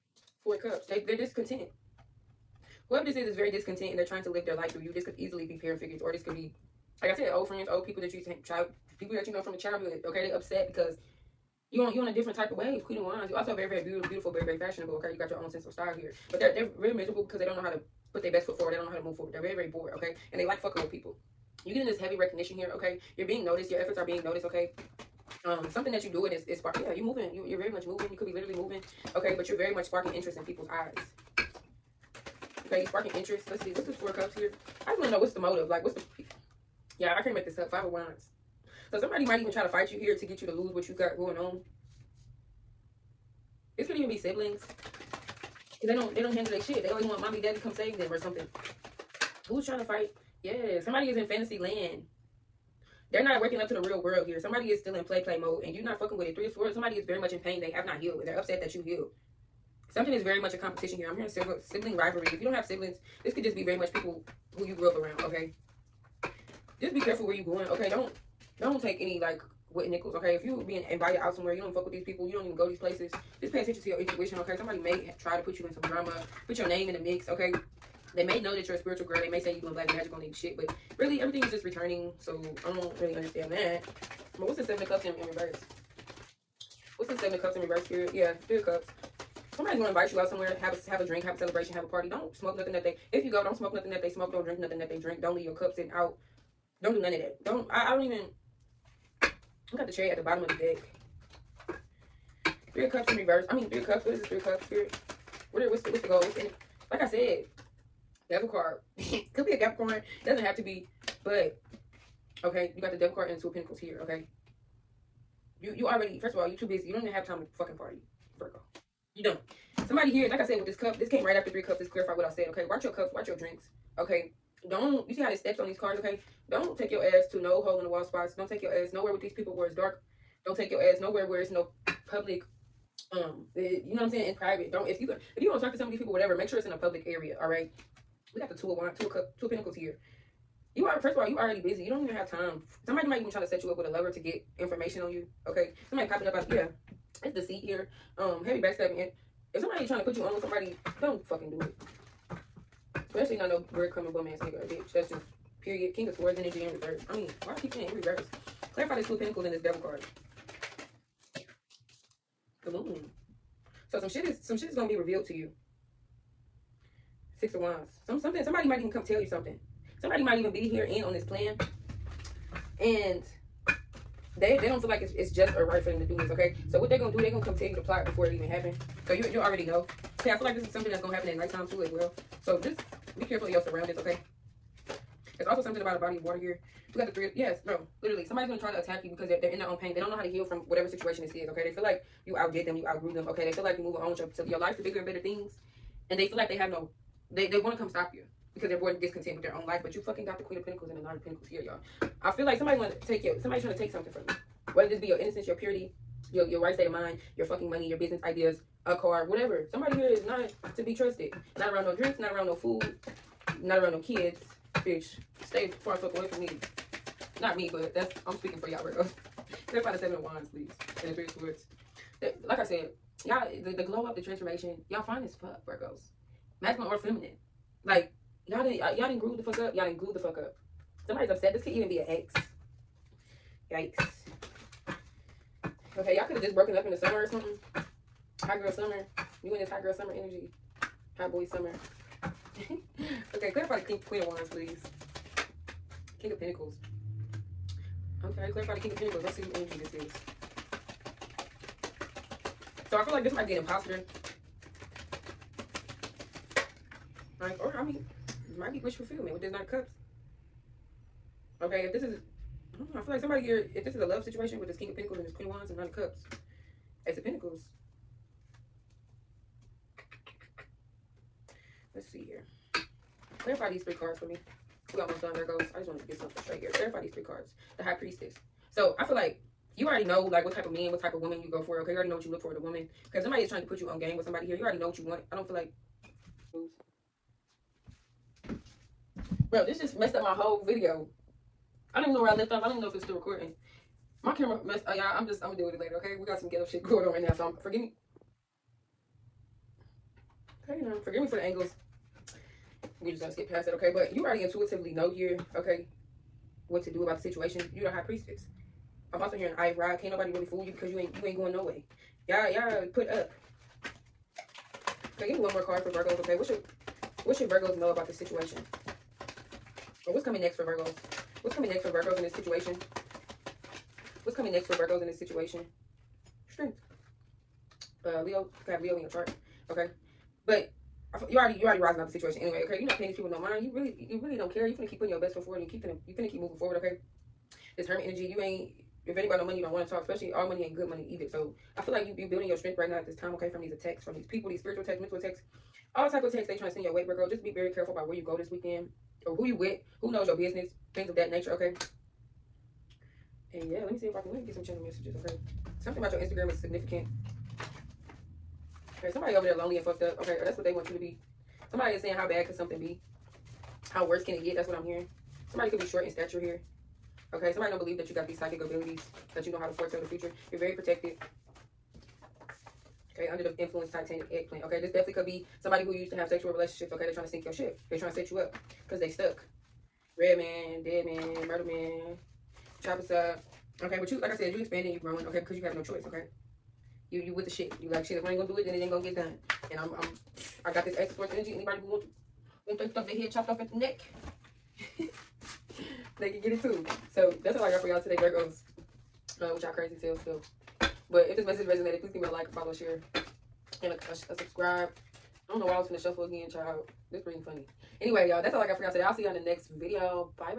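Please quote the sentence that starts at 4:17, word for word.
Like, or I mean, might be wish fulfillment with this Knight of Cups.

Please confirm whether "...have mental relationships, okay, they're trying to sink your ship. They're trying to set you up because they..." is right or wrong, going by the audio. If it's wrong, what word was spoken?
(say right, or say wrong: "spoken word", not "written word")
wrong: "sexual", not "mental".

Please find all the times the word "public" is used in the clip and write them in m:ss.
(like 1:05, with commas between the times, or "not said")
2:12, 2:16.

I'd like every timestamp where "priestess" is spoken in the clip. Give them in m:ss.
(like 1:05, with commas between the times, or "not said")
4:37, 5:08.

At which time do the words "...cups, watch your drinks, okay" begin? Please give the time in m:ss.
2:02.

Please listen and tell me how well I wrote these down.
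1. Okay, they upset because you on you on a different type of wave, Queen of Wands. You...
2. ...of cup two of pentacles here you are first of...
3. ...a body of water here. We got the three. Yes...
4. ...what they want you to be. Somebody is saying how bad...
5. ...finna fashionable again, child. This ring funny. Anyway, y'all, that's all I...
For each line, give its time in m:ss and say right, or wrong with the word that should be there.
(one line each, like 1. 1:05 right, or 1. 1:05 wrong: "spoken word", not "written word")
1. 0:10 right
2. 2:19 right
3. 3:05 right
4. 6:00 right
5. 6:45 wrong: "shuffle", not "fashionable".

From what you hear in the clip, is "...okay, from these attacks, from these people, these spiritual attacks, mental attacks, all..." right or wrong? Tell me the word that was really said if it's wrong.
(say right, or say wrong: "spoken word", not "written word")
right.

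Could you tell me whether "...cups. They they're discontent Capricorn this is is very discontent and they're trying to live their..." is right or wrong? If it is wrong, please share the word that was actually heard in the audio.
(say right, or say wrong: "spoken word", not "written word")
wrong: "Whoever", not "Capricorn".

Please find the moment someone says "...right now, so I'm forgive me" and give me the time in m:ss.
4:57.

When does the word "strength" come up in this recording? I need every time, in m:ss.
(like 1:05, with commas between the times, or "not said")
5:26, 5:42.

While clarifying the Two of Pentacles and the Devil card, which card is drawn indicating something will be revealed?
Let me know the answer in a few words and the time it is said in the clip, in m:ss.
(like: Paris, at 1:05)
The Moon, at 2:42.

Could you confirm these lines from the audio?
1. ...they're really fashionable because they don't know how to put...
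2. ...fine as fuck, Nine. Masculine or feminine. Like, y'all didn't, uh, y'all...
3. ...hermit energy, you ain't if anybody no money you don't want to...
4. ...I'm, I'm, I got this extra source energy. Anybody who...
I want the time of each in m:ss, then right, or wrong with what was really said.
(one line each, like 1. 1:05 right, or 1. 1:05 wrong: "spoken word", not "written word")
1. 0:16 wrong: "miserable", not "fashionable"
2. 3:45 wrong: "Virgos", not "Nine"
3. 5:37 right
4. 6:29 right.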